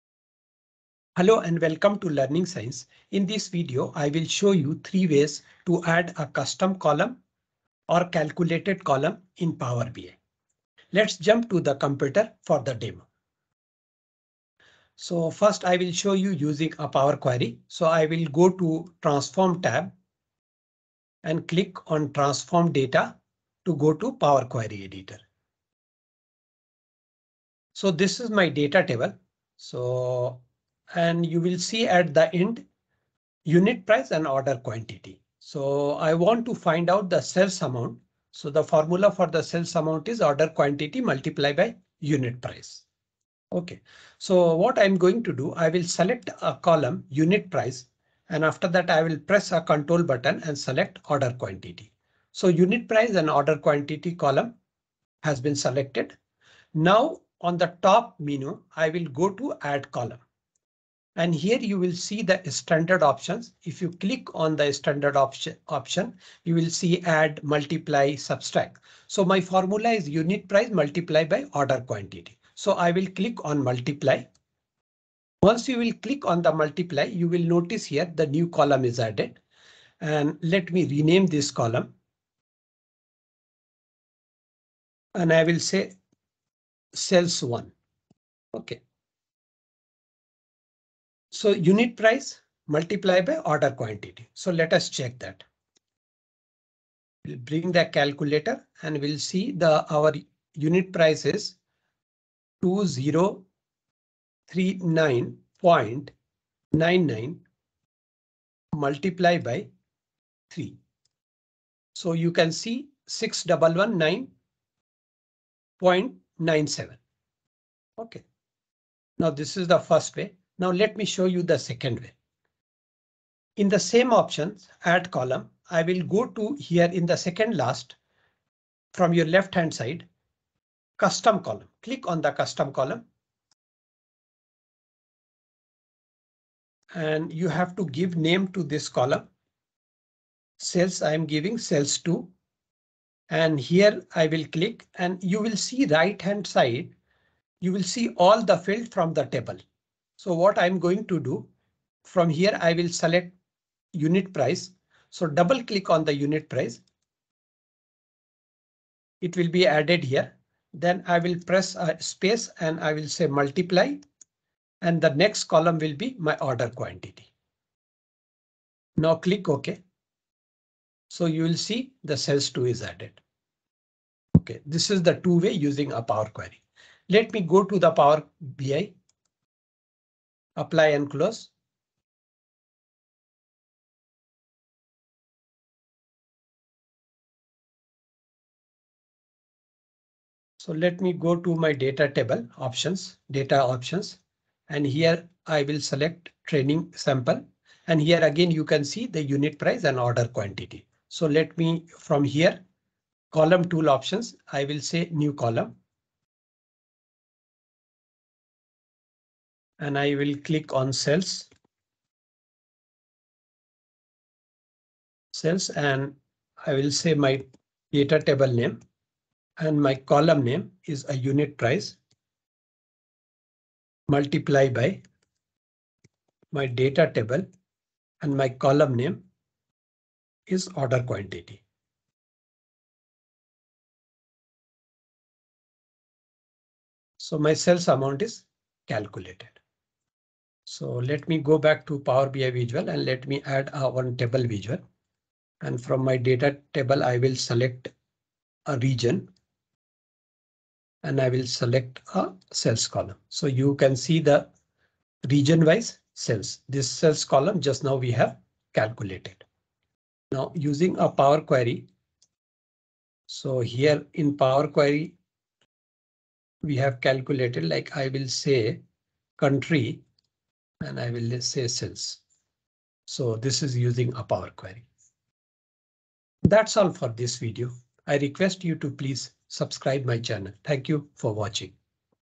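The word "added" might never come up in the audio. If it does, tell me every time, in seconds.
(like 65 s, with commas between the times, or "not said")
78 s, 159 s, 172 s.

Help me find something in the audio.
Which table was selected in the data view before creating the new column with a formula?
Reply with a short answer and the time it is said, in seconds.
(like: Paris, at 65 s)
training sample, at 196 s.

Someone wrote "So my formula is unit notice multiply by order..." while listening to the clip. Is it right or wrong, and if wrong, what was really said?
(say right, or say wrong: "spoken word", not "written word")
wrong: "price", not "notice".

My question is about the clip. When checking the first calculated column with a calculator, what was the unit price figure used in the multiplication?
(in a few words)
2039.99.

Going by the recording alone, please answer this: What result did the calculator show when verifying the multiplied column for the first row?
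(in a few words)
6119.97.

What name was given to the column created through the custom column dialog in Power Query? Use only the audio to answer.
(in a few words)
Sales 2.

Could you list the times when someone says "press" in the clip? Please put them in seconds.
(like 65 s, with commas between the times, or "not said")
49 s, 161 s.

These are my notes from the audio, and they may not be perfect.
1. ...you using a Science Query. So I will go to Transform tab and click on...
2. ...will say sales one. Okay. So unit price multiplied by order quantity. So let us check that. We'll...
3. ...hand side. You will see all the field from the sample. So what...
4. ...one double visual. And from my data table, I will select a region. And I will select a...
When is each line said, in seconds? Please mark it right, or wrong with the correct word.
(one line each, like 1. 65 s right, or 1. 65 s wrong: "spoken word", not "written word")
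1. 16 s wrong: "Power", not "Science"
2. 85 s right
3. 146 s wrong: "table", not "sample"
4. 243 s wrong: "table", not "double".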